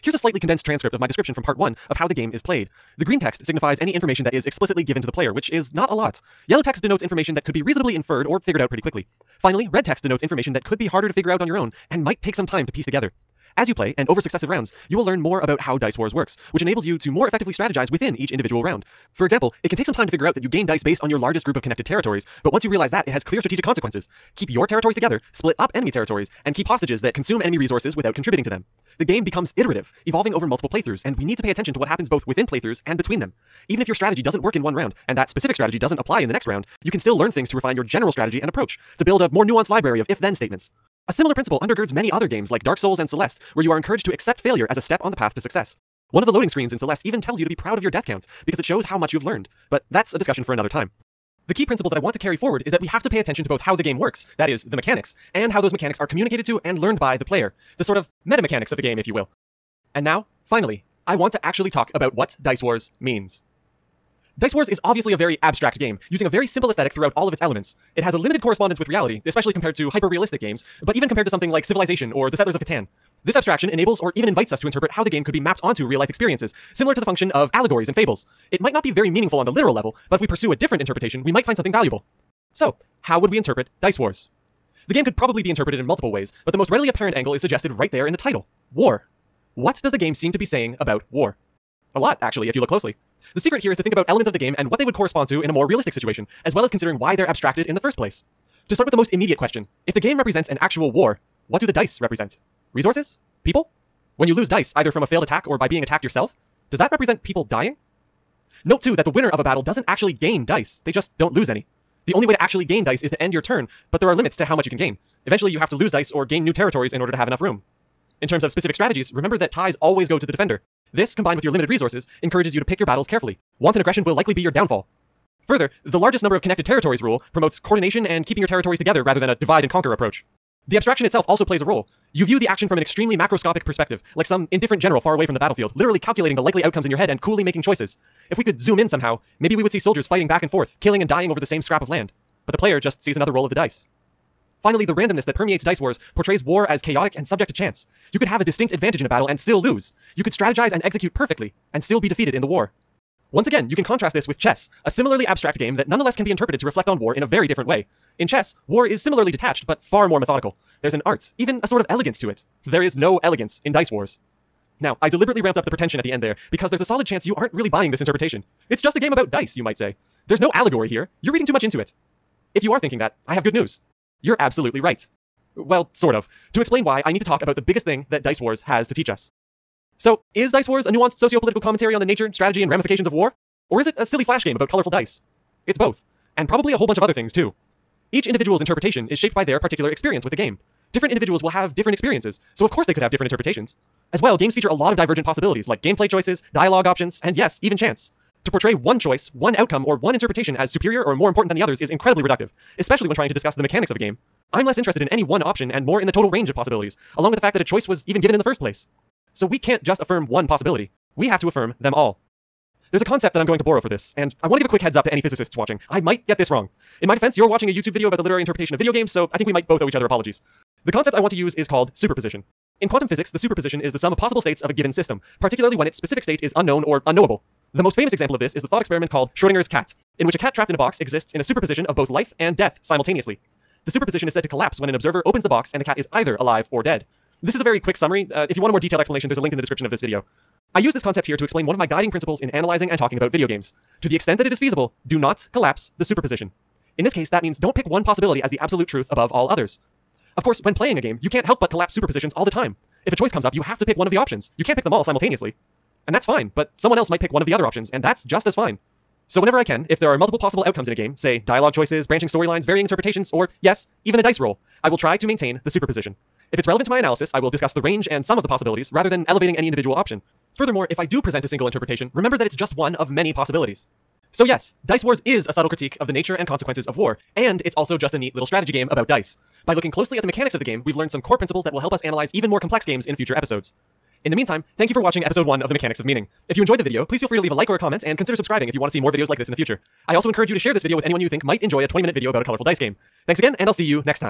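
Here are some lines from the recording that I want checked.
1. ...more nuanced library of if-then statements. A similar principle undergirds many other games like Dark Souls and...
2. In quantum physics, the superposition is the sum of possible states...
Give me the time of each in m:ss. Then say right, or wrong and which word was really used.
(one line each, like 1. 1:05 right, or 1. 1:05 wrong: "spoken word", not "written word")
1. 0:39 right
2. 3:42 right.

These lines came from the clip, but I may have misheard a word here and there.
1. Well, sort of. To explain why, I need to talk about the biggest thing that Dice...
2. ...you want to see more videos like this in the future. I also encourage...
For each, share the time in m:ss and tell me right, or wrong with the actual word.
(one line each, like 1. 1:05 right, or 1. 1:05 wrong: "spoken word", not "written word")
1. 2:55 right
2. 4:48 right.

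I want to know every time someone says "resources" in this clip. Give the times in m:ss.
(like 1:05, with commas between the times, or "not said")
0:27, 1:42, 2:01.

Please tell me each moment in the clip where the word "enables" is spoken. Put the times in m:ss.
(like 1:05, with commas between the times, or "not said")
0:16, 1:13.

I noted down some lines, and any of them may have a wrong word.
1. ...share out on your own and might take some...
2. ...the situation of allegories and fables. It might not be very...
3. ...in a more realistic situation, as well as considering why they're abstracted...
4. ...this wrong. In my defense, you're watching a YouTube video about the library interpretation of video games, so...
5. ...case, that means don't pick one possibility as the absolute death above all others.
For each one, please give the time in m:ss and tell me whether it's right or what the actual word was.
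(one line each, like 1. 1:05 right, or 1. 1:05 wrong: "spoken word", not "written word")
1. 0:11 wrong: "figure", not "share"
2. 1:17 wrong: "function", not "situation"
3. 1:35 right
4. 3:36 wrong: "literary", not "library"
5. 4:07 wrong: "truth", not "death".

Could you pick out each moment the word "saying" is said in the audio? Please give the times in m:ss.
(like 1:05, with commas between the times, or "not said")
1:30.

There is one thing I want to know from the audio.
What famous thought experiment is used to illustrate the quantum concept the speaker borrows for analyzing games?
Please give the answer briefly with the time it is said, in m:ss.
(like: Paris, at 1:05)
Schrodinger's cat, at 3:49.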